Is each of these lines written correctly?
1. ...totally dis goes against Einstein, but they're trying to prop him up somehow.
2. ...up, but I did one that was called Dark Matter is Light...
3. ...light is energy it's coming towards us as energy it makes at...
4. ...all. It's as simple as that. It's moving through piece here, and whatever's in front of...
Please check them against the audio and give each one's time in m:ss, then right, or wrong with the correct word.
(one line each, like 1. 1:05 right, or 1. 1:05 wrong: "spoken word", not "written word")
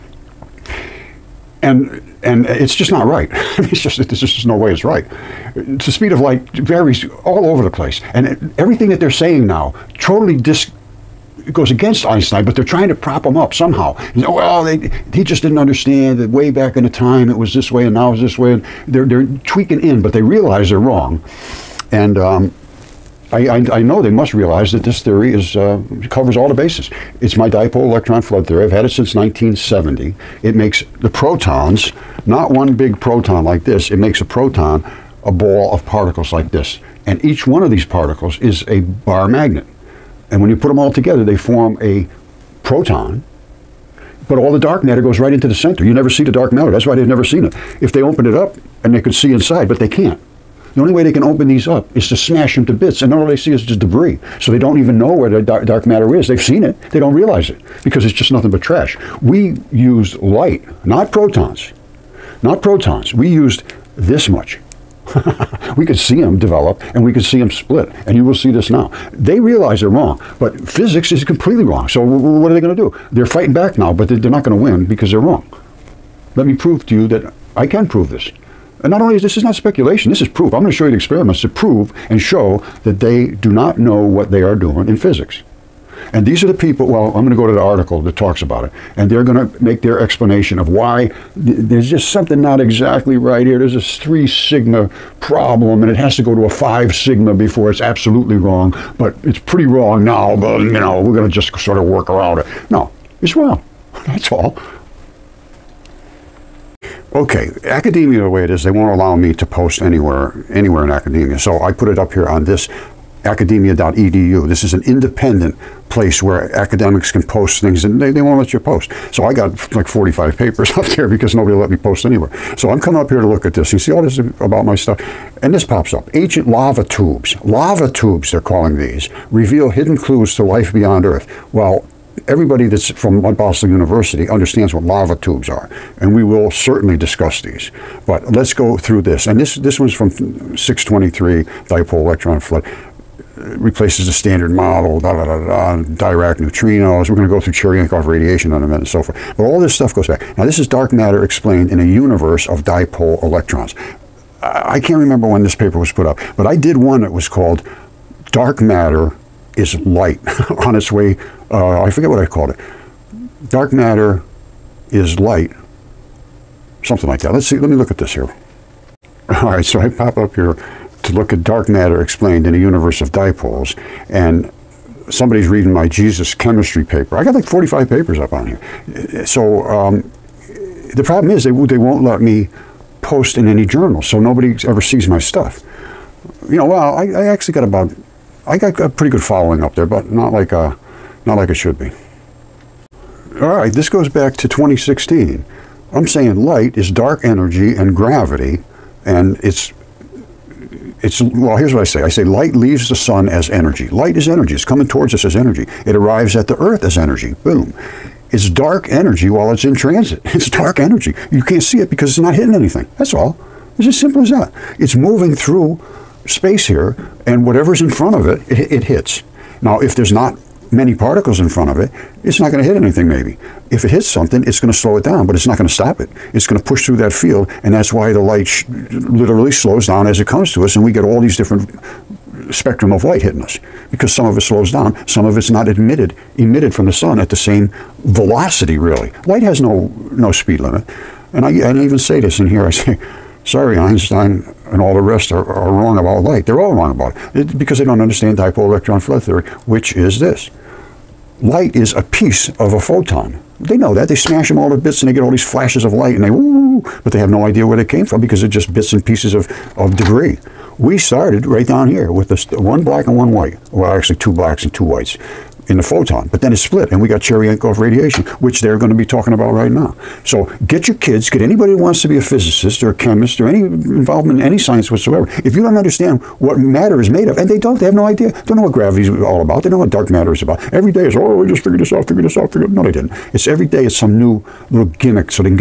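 1. 0:09 right
2. 2:36 right
3. 3:23 wrong: "arrives", not "makes"
4. 3:33 wrong: "space", not "piece".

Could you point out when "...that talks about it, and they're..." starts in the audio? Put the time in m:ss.
1:28.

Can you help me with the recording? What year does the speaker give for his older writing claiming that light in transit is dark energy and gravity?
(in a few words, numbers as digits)
2016.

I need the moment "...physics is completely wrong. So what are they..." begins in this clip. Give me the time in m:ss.
1:10.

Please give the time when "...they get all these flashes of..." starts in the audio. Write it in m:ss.
4:15.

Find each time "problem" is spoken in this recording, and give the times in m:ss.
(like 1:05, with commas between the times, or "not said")
1:35, 3:01.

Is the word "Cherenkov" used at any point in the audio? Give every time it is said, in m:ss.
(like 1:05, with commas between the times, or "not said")
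2:27, 4:27.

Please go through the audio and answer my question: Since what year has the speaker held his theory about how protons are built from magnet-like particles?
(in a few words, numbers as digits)
1970.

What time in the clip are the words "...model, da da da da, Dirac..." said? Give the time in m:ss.
2:24.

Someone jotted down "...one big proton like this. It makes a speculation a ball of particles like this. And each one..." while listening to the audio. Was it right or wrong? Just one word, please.
wrong.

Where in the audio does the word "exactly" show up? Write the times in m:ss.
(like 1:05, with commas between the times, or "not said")
1:32.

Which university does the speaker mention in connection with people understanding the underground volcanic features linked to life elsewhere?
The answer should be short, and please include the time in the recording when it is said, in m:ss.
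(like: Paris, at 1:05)
Boston University, at 2:13.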